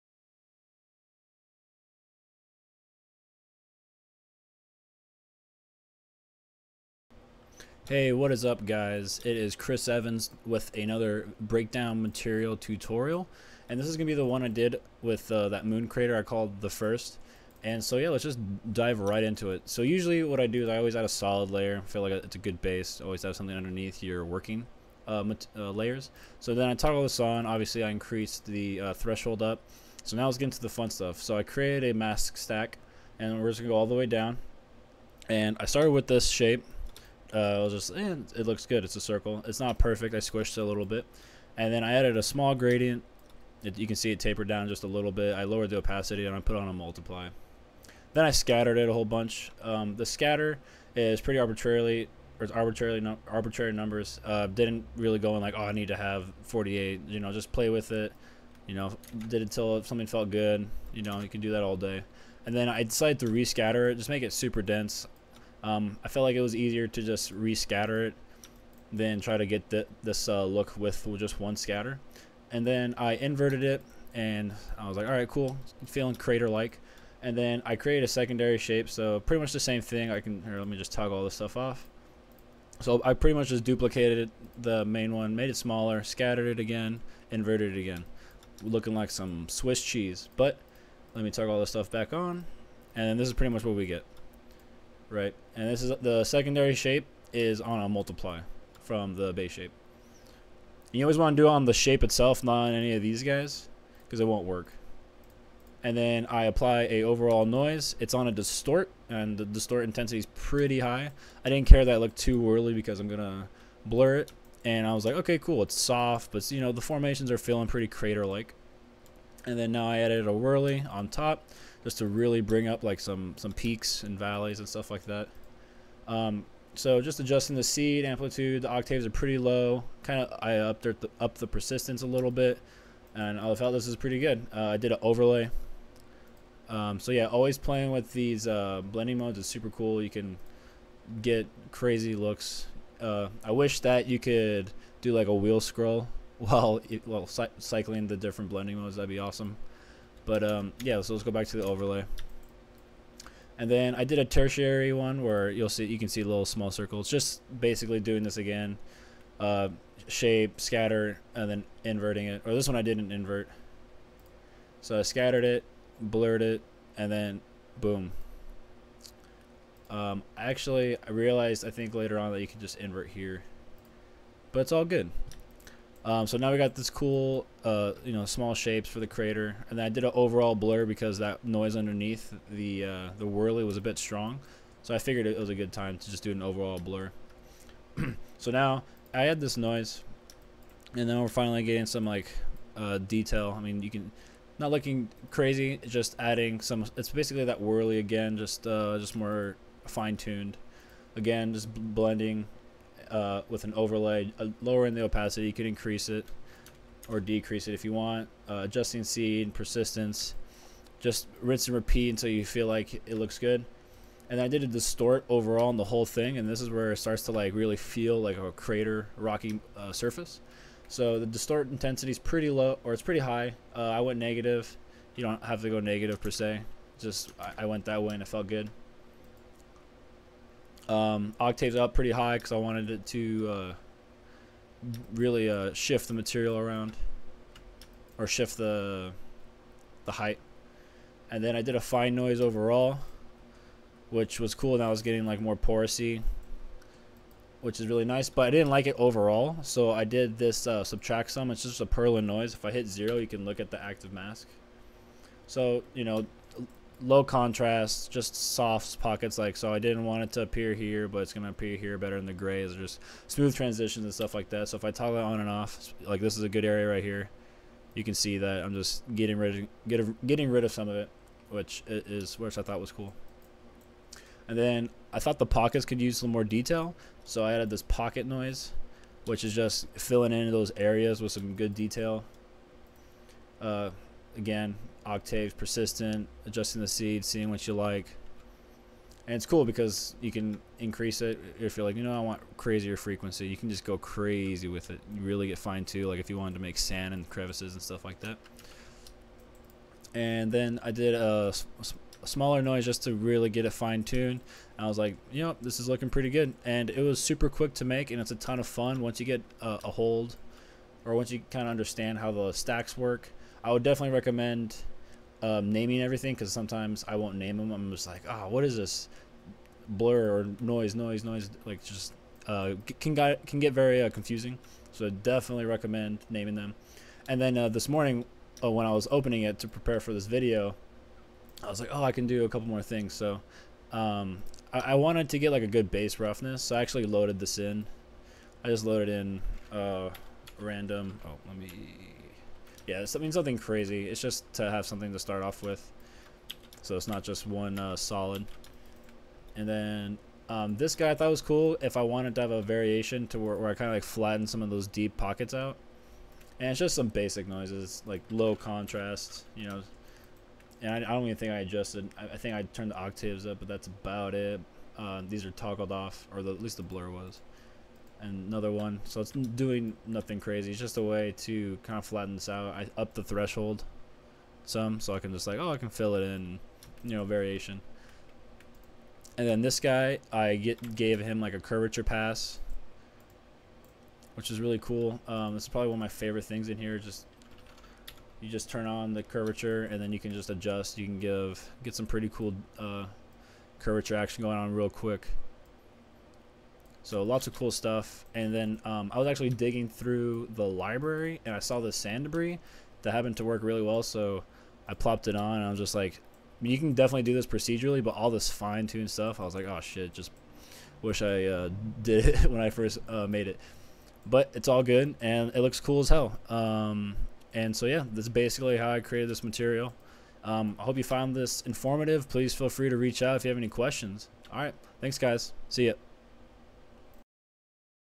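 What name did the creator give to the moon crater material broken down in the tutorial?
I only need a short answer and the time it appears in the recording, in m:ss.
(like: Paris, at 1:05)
the first, at 0:16.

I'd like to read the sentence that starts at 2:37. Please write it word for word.
Just basically doing this again, uh, shape, scatter, and then inverting it.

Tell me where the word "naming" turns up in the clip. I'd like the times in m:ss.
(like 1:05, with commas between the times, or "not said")
5:15, 5:26.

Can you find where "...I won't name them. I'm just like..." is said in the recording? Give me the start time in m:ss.
5:17.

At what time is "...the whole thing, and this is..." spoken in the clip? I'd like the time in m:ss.
3:35.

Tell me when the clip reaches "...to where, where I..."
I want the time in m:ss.
5:53.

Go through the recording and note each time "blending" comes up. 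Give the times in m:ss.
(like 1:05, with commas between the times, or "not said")
2:18, 2:28, 3:21.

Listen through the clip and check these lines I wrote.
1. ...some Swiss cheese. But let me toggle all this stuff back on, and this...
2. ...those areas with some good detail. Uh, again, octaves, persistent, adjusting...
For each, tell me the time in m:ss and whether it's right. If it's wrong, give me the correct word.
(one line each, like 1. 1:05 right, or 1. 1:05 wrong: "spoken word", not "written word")
1. 1:29 right
2. 4:40 right.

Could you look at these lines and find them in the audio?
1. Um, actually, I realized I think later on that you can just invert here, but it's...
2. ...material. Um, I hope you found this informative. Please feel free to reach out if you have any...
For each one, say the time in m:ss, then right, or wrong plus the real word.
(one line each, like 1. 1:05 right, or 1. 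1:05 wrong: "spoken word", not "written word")
1. 2:49 right
2. 6:59 right.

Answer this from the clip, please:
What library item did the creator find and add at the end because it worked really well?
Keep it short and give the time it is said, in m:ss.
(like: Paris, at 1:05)
sand debris, at 6:41.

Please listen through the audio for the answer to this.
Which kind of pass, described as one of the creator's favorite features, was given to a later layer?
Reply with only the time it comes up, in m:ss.
6:21.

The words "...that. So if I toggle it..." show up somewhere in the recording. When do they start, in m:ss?
4:24.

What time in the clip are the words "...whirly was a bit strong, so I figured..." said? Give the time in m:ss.
3:03.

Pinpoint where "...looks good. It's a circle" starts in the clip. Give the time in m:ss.
0:38.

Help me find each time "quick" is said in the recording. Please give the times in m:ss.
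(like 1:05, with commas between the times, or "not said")
5:07, 6:34.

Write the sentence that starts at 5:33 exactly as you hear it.
So um, I, I, wanted to get like a good base roughness.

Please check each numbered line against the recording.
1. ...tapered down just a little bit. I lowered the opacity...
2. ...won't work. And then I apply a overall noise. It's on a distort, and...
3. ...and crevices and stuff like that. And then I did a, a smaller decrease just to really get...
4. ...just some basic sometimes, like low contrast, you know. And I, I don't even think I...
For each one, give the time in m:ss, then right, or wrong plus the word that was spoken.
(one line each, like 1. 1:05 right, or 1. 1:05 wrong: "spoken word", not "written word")
1. 0:44 right
2. 1:44 right
3. 4:57 wrong: "noise", not "decrease"
4. 5:56 wrong: "noises", not "sometimes".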